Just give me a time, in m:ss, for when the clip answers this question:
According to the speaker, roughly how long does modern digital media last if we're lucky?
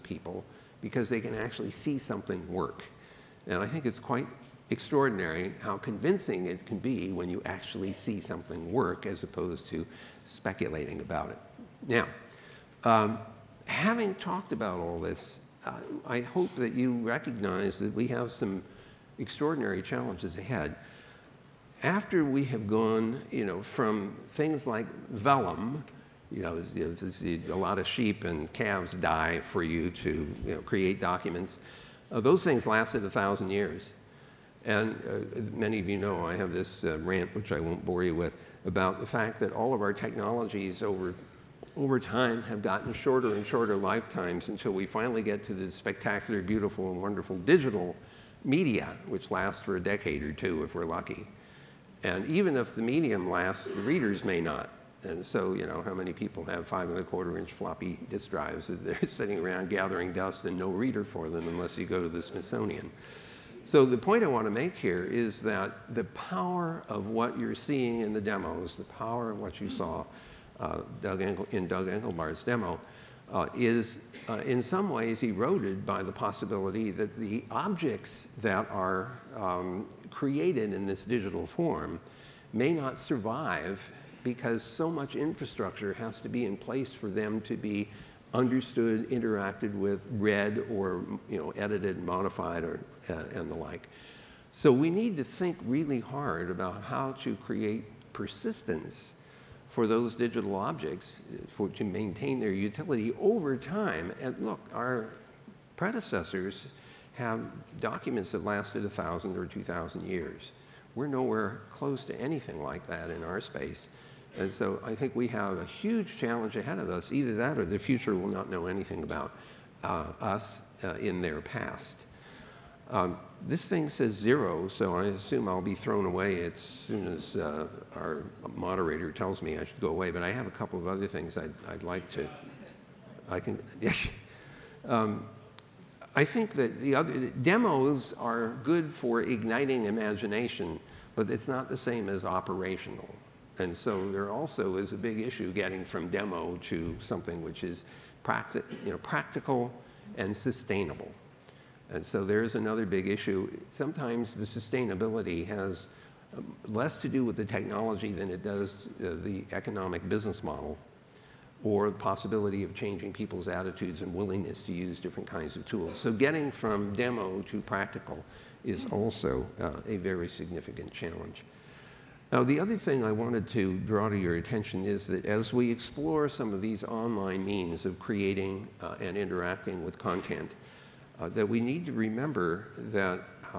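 0:49.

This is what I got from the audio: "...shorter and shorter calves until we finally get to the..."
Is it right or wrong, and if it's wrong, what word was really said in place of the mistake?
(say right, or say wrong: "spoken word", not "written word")
wrong: "lifetimes", not "calves".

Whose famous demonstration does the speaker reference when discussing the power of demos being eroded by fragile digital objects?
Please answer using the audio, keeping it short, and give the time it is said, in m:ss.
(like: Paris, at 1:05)
Doug Engelbart, at 1:11.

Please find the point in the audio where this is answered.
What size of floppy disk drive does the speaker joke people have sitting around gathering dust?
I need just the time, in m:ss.
0:56.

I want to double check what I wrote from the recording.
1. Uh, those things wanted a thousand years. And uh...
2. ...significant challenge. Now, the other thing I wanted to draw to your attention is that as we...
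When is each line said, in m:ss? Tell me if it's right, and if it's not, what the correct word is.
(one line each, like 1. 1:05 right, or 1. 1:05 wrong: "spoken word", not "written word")
1. 0:32 wrong: "lasted", not "wanted"
2. 2:50 right.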